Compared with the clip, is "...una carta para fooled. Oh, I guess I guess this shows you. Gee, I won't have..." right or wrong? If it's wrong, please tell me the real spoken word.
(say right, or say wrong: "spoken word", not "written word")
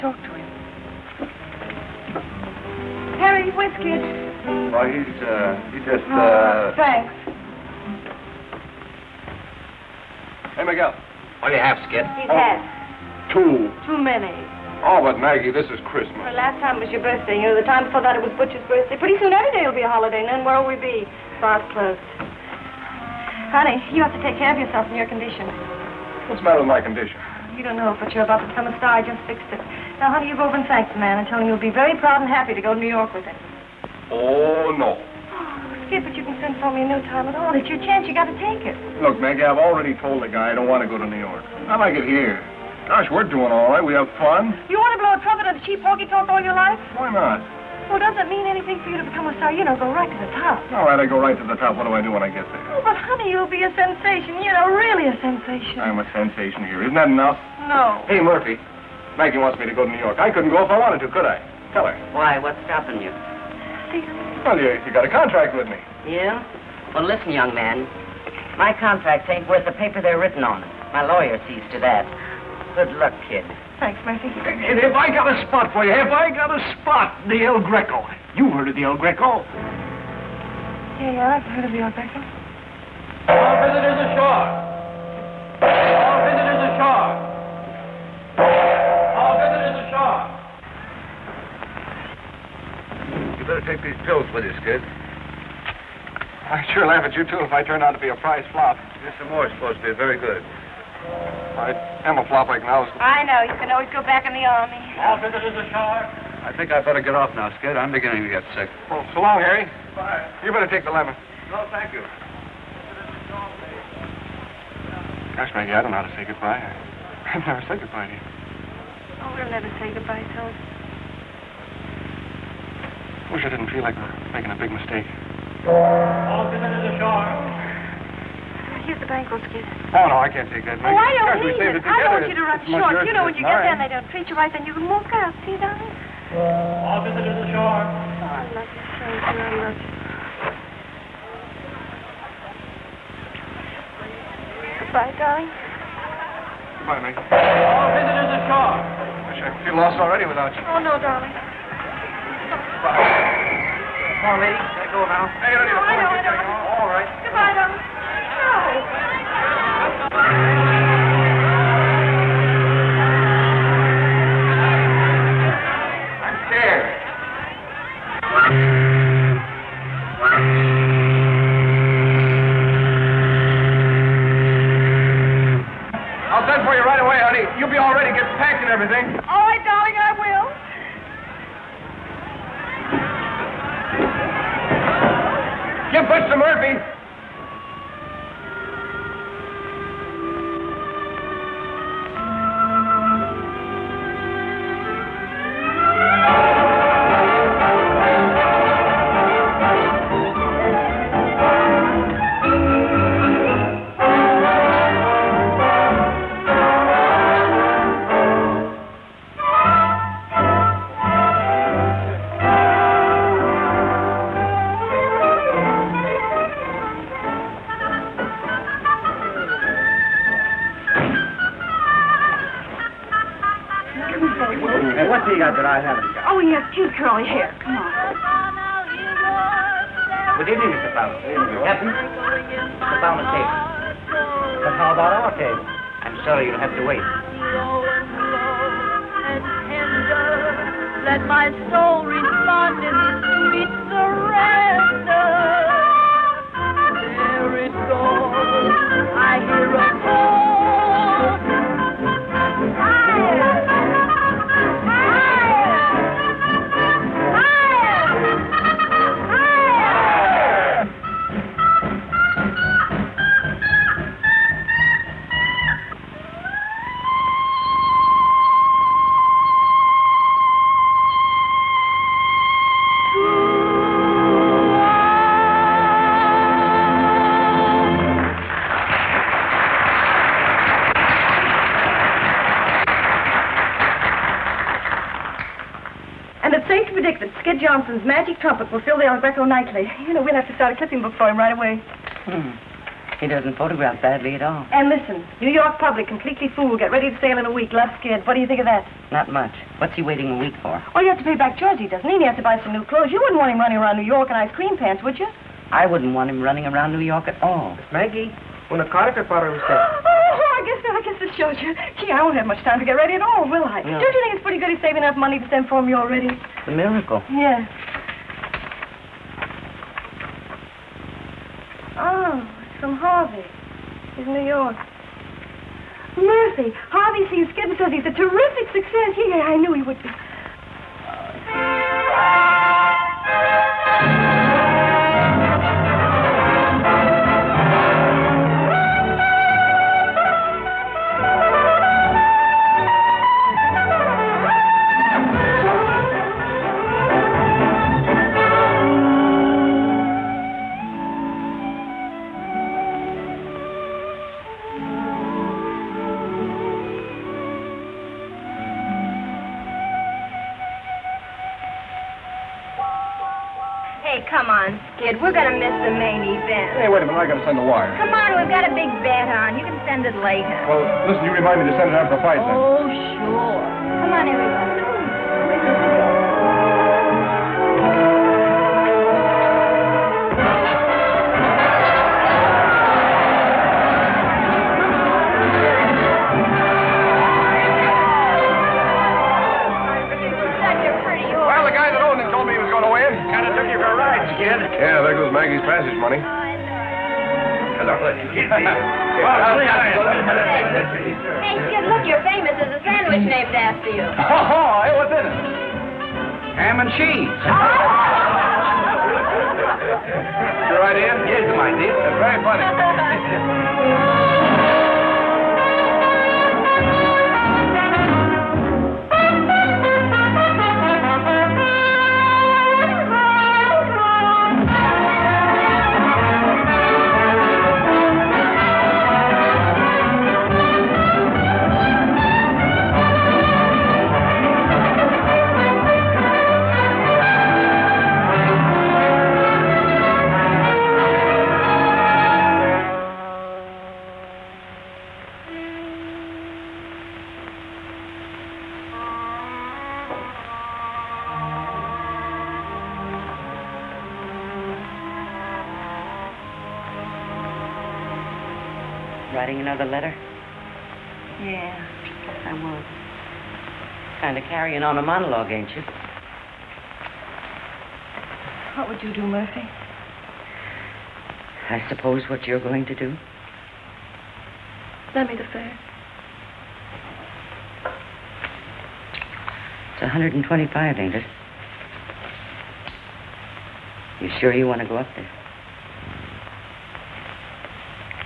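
wrong: "usted", not "fooled".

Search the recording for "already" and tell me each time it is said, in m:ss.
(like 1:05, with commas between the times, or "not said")
0:39, 2:29, 5:15.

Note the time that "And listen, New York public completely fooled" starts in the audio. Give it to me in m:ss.
4:54.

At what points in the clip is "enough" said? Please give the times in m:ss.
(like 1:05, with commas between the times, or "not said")
0:57, 5:15.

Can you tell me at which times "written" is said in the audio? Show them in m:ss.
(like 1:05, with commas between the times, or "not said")
1:10.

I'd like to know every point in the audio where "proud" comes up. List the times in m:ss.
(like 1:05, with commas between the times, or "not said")
0:31.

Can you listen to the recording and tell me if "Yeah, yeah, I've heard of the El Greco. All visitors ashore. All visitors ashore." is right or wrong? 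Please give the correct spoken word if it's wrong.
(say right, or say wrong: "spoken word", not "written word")
right.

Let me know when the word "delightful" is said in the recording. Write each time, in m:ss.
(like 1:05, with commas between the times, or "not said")
not said.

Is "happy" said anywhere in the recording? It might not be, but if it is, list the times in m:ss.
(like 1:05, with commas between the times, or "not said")
0:32.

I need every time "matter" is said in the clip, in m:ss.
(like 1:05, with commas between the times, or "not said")
0:26.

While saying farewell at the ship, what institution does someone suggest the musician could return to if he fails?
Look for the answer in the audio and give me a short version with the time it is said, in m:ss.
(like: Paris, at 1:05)
the army, at 1:44.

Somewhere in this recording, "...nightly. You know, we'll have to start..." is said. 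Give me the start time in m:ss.
4:49.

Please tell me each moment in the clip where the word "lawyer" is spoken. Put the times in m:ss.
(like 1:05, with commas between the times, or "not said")
1:11.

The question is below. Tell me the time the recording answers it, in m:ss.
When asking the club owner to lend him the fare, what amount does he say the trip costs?
8:00.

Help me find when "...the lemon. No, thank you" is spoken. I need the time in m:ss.
1:50.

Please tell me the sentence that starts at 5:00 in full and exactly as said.
Oh, you have to pay back Jersey, doesn't he?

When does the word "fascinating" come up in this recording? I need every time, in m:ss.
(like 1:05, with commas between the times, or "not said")
not said.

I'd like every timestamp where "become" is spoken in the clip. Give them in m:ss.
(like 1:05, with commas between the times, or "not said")
0:28, 0:49.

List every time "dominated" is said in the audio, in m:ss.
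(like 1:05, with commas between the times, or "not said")
not said.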